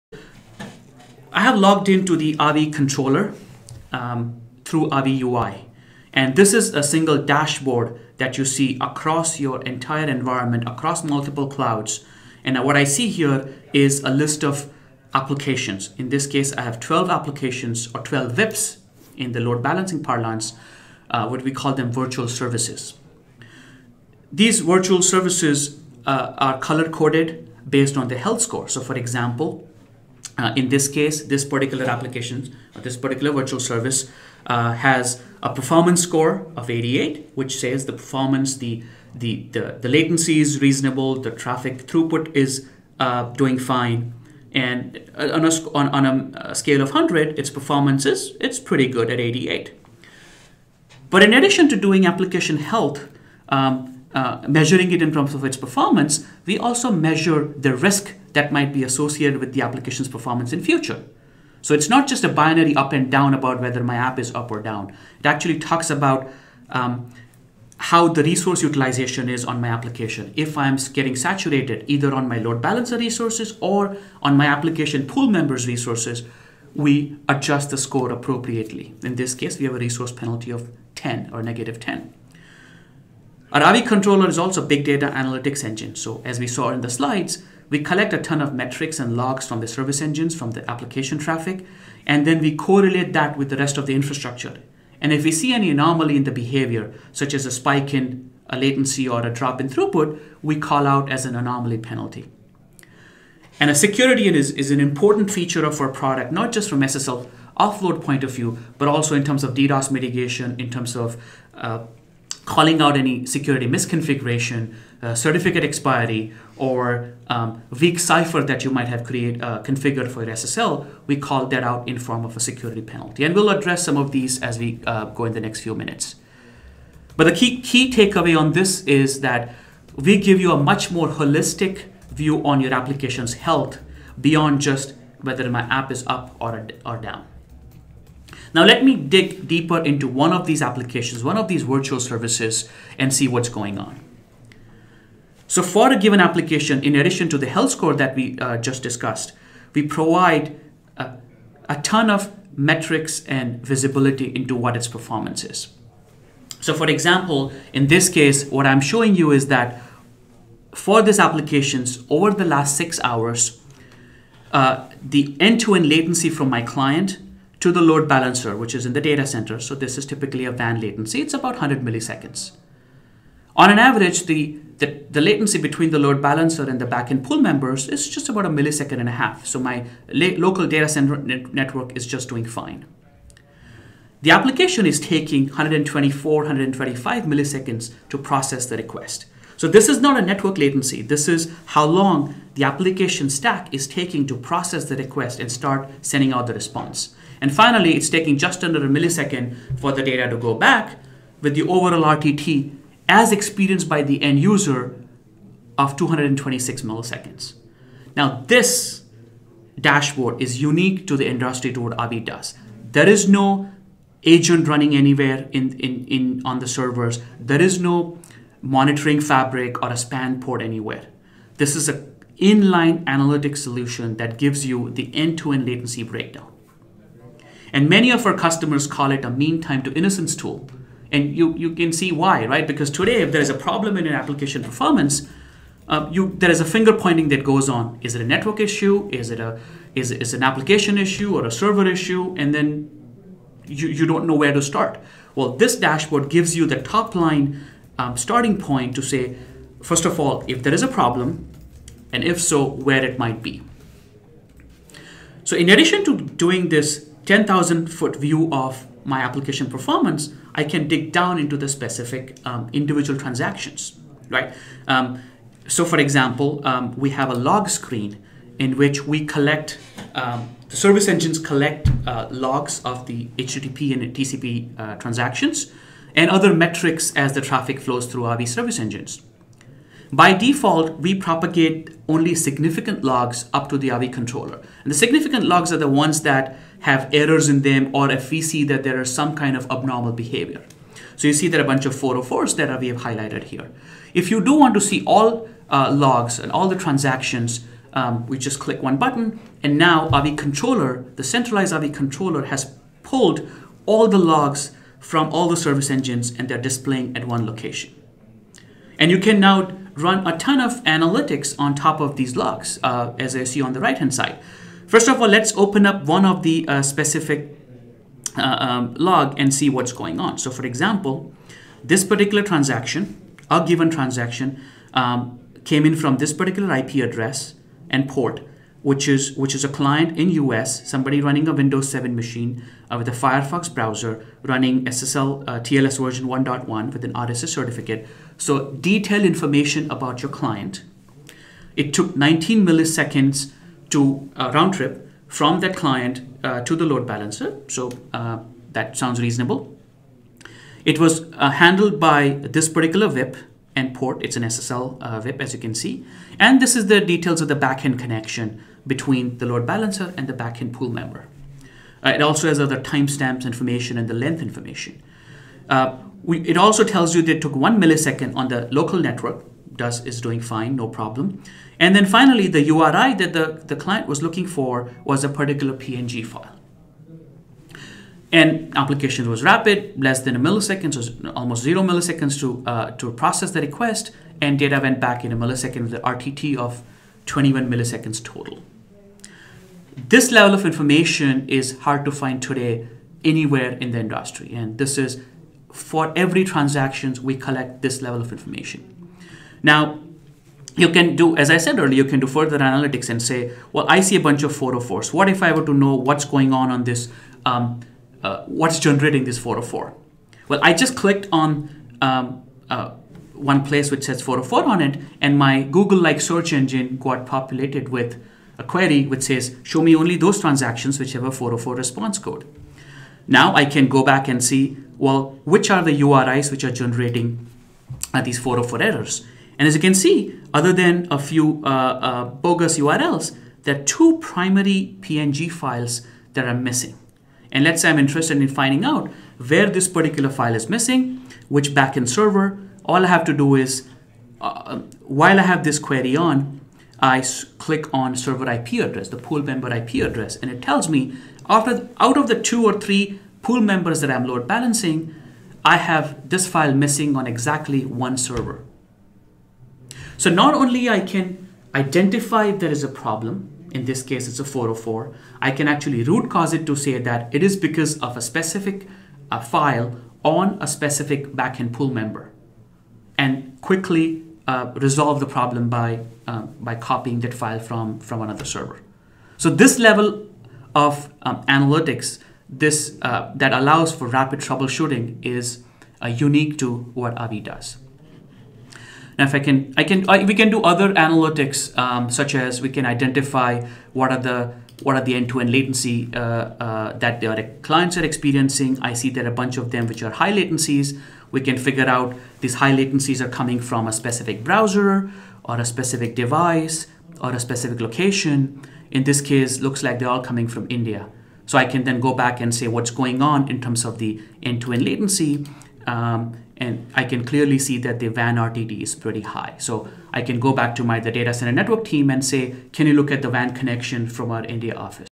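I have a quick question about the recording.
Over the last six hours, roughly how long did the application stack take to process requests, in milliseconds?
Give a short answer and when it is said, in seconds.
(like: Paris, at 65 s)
125, at 186 s.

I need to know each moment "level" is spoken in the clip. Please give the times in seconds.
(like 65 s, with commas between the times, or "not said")
390 s, 398 s, 479 s.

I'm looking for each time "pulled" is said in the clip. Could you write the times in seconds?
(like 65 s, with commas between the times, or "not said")
303 s.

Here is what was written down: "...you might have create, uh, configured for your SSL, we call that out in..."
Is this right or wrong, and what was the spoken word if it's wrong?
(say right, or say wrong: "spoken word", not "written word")
right.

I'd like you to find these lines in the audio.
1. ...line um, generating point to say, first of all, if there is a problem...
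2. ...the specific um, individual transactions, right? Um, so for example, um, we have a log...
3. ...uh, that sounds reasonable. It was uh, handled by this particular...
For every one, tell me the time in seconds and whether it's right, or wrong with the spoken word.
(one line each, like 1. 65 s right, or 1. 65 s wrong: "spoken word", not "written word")
1. 247 s wrong: "starting", not "generating"
2. 261 s right
3. 348 s right.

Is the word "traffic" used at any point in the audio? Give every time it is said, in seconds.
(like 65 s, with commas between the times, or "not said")
41 s, 91 s, 277 s.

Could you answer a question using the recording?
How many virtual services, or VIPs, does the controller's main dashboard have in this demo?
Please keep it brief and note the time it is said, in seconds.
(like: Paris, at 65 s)
12, at 16 s.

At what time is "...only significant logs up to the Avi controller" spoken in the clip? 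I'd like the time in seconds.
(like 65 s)
282 s.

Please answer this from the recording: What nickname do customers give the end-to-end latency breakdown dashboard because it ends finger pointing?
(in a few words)
mean time to innocence tool.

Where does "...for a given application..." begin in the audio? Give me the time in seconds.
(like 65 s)
145 s.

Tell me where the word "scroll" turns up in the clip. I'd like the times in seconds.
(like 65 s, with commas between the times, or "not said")
not said.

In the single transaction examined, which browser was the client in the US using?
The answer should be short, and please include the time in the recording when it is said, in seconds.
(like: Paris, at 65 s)
Firefox, at 333 s.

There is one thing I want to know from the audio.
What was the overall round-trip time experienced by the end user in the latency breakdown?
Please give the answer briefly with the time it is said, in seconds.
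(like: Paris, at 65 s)
226 milliseconds, at 205 s.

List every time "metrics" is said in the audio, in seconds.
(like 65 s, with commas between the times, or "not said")
88 s, 152 s, 276 s.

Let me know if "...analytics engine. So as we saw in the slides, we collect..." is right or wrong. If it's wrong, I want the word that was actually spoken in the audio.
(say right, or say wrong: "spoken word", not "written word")
right.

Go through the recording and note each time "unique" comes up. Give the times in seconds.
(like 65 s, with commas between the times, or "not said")
210 s, 486 s.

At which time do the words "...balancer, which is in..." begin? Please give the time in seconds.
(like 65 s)
168 s.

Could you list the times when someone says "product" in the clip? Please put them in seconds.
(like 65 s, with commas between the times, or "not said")
105 s.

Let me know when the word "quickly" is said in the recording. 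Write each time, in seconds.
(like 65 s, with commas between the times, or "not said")
473 s.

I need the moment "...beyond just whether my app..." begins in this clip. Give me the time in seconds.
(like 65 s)
134 s.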